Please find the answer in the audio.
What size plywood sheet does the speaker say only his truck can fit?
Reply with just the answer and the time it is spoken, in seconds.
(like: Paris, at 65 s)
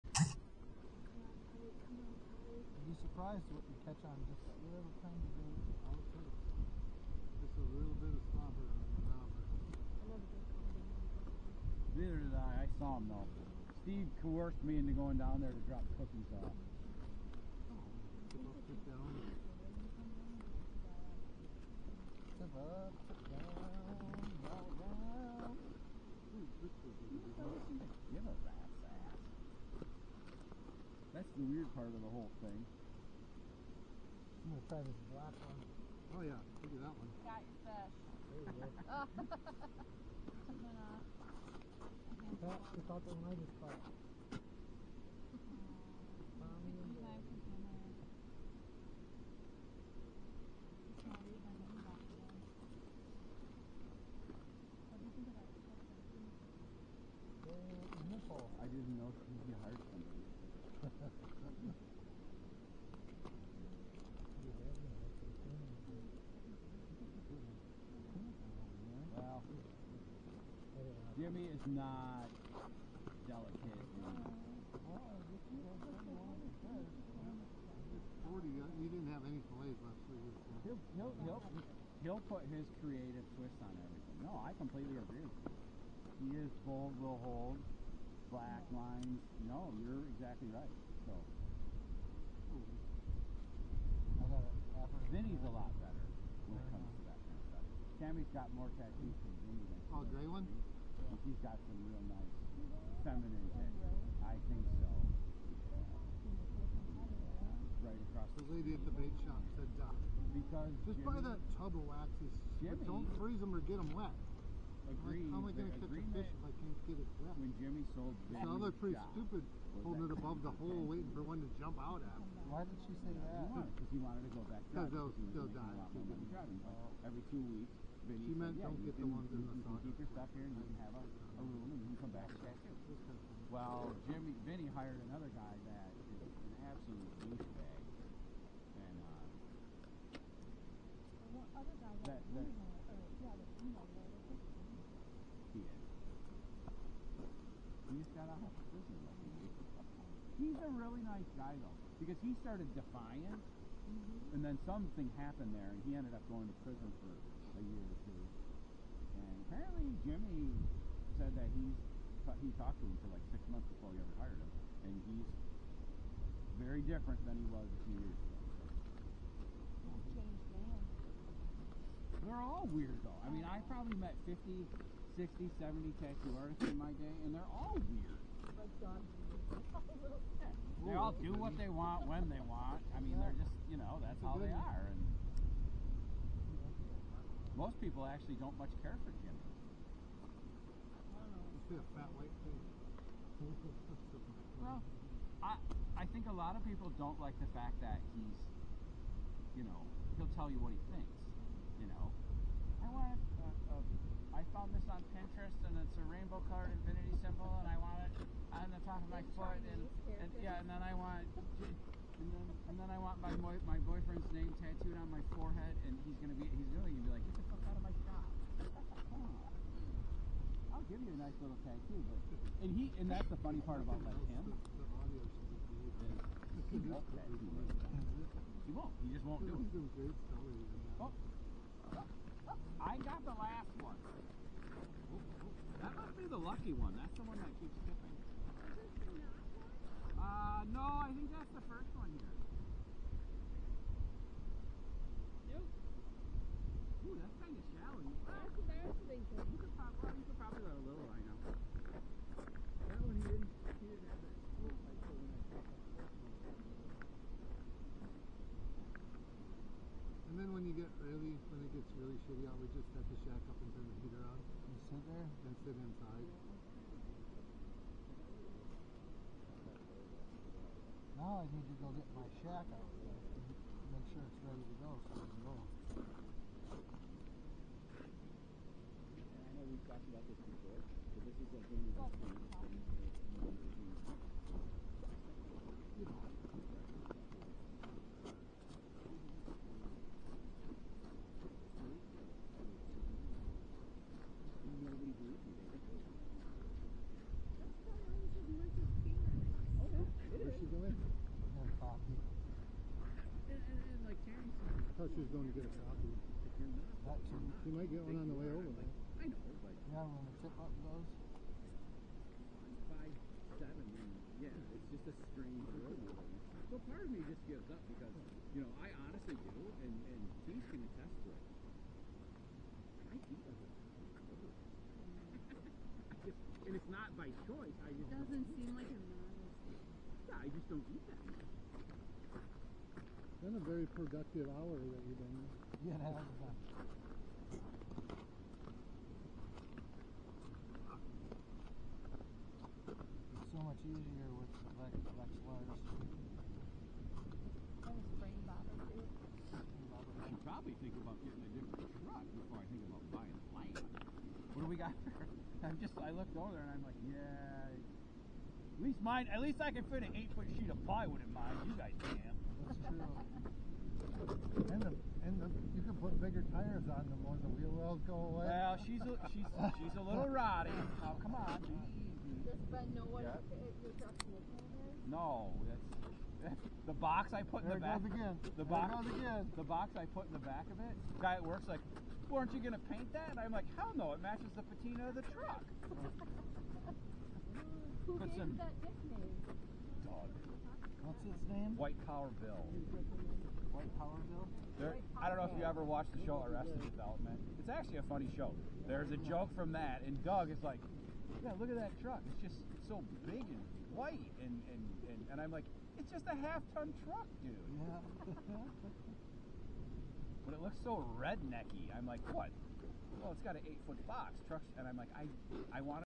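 8 foot, at 360 s.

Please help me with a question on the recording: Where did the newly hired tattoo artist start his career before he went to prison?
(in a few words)
Defiance.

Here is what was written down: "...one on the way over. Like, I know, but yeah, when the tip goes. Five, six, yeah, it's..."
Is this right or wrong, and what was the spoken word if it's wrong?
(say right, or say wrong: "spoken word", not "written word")
wrong: "seven", not "six".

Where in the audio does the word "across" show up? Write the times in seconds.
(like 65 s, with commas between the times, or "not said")
108 s.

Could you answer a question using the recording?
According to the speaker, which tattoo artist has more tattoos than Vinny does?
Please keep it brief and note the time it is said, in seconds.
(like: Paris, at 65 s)
Cammy, at 97 s.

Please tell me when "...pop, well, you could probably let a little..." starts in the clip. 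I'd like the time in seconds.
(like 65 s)
249 s.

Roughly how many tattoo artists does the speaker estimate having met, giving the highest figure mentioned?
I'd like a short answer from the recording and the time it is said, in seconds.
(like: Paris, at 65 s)
70, at 175 s.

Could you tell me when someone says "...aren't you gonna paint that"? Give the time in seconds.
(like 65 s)
382 s.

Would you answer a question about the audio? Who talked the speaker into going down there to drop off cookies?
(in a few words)
Steve.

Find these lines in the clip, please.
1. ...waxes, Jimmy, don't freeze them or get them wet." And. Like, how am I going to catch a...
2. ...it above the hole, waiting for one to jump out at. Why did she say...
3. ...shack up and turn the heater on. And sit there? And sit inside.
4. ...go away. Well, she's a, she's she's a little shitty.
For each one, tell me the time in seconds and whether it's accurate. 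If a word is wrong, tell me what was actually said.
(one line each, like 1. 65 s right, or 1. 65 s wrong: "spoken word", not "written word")
1. 111 s wrong: "Agreed", not "And"
2. 120 s right
3. 263 s right
4. 368 s wrong: "rotty", not "shitty".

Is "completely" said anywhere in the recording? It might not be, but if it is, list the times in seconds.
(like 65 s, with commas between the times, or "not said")
84 s.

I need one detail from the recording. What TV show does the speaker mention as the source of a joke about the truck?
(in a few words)
Arrested Development.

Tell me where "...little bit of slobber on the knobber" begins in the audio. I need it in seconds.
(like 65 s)
7 s.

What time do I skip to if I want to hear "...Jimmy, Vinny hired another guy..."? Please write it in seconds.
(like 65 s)
134 s.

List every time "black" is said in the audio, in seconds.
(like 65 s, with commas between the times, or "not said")
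35 s, 88 s.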